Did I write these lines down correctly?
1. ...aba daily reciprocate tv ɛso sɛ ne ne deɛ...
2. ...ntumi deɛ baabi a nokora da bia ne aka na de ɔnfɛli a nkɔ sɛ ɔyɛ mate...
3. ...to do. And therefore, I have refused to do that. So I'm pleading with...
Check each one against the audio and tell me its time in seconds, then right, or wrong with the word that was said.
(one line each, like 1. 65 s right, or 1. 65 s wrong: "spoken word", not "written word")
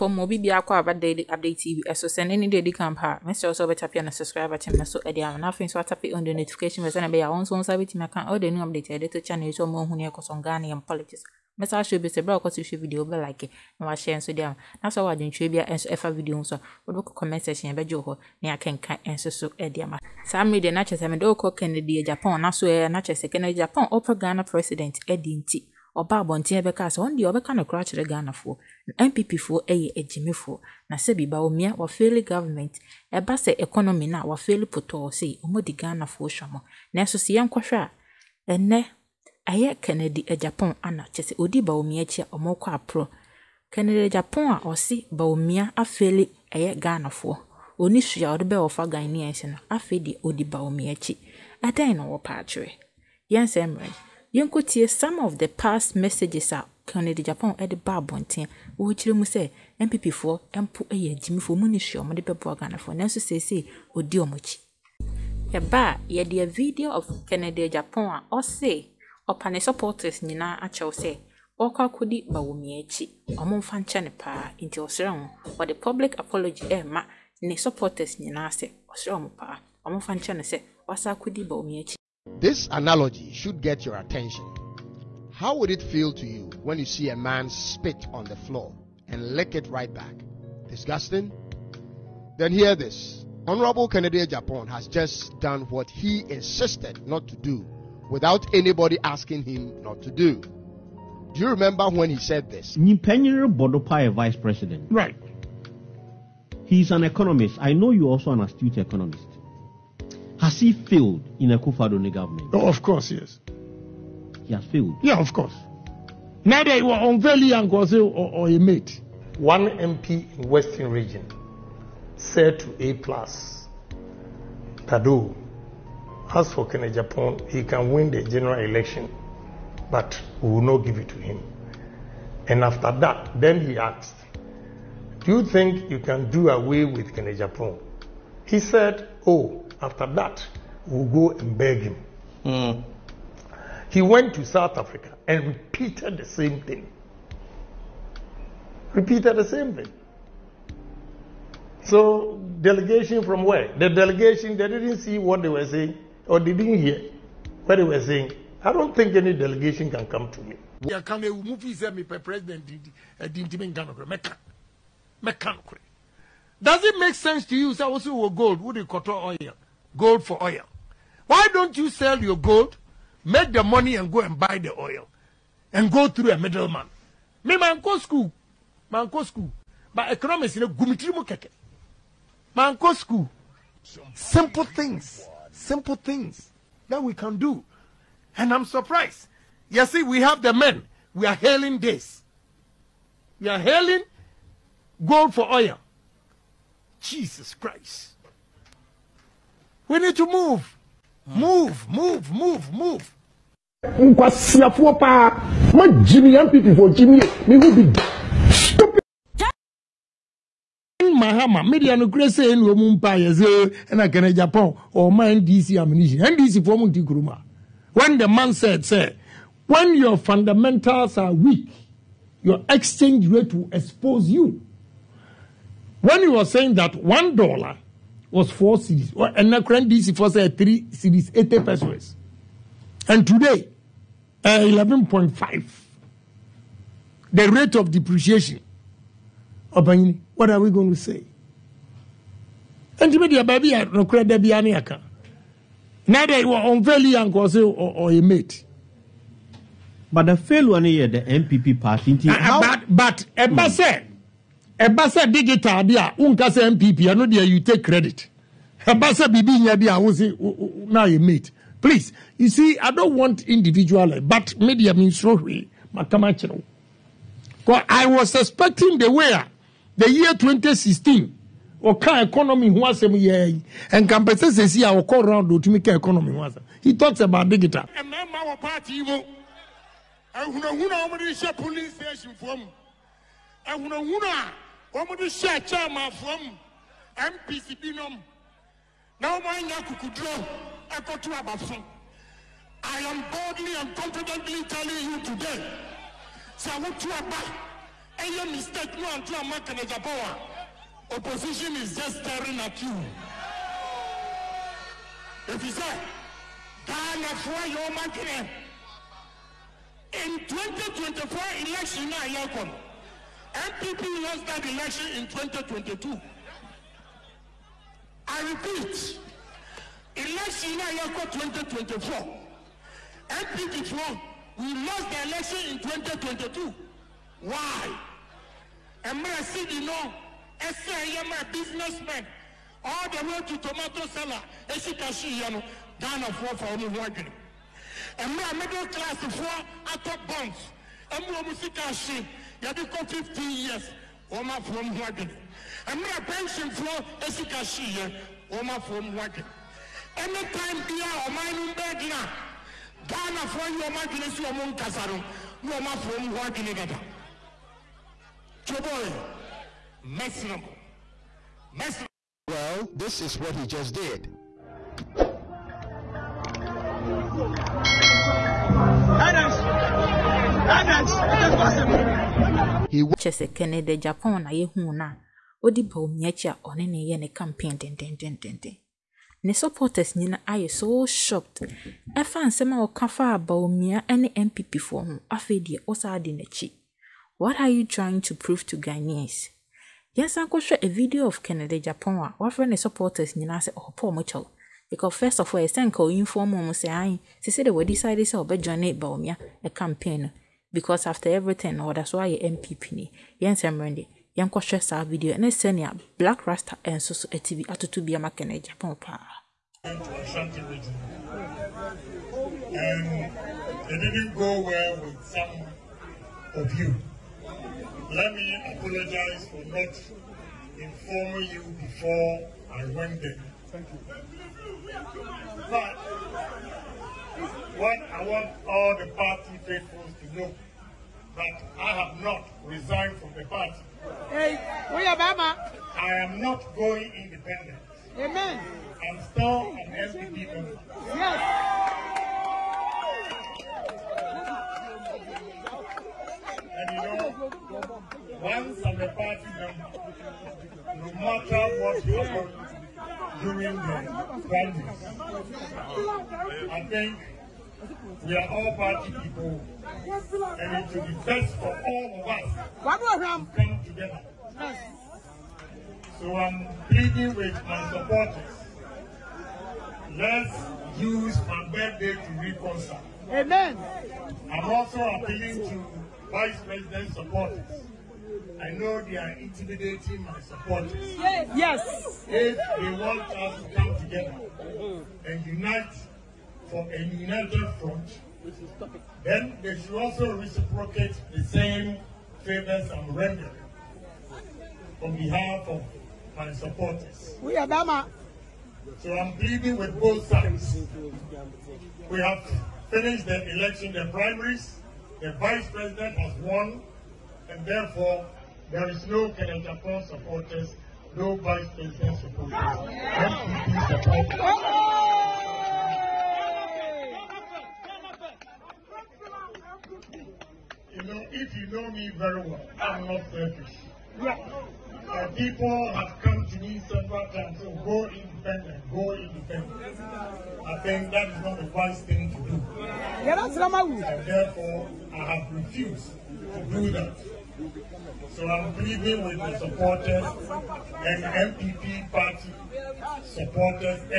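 1. 0 s wrong: "update", not "reciprocate"
2. 243 s right
3. 532 s right.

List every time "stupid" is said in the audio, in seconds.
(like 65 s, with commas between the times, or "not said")
208 s.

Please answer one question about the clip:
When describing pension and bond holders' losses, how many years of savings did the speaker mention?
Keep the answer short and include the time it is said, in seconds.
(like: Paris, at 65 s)
15 years, at 343 s.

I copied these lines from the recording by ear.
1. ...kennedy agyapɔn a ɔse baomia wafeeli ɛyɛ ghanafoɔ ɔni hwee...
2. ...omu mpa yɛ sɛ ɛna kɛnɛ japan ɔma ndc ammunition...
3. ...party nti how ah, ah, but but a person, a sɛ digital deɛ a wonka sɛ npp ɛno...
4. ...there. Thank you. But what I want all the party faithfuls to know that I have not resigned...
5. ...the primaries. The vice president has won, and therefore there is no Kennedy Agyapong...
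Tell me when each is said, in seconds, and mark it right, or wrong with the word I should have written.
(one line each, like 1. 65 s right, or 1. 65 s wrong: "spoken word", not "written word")
1. 43 s wrong: "afeeli", not "wafeeli"
2. 212 s right
3. 251 s right
4. 423 s right
5. 503 s right.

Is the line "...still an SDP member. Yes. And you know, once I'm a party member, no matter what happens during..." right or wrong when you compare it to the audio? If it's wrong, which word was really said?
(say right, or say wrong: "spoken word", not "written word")
right.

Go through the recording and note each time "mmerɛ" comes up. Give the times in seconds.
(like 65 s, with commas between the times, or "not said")
53 s, 345 s.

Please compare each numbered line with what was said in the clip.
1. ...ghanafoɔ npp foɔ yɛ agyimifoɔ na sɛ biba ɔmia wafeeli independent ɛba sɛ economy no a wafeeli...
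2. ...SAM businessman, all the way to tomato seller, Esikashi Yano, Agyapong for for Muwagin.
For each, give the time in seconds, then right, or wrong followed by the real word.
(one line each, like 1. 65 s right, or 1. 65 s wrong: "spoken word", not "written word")
1. 28 s wrong: "government", not "independent"
2. 330 s wrong: "Ghana", not "Agyapong".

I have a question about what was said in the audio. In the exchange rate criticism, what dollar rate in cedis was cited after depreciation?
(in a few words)
11.5.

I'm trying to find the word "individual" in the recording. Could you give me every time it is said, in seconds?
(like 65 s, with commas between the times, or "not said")
263 s.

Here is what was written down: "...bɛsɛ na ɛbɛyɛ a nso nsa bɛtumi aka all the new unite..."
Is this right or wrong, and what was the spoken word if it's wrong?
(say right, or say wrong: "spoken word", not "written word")
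wrong: "update", not "unite".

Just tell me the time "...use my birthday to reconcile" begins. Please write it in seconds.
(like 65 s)
471 s.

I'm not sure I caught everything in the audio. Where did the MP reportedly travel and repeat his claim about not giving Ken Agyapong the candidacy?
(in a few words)
South Africa.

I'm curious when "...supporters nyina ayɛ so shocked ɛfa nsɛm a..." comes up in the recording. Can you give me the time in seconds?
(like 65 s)
379 s.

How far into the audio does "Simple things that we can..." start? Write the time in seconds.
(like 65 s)
185 s.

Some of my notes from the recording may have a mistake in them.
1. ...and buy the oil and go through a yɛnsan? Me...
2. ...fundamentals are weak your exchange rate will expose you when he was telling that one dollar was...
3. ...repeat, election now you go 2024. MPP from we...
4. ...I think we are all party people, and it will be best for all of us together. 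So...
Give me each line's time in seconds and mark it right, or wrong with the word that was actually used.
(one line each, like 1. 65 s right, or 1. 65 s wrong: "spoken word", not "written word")
1. 174 s wrong: "middleman", not "yɛnsan"
2. 220 s wrong: "saying", not "telling"
3. 318 s right
4. 456 s right.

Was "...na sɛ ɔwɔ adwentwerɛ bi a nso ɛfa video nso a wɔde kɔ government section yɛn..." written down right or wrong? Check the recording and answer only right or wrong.
wrong.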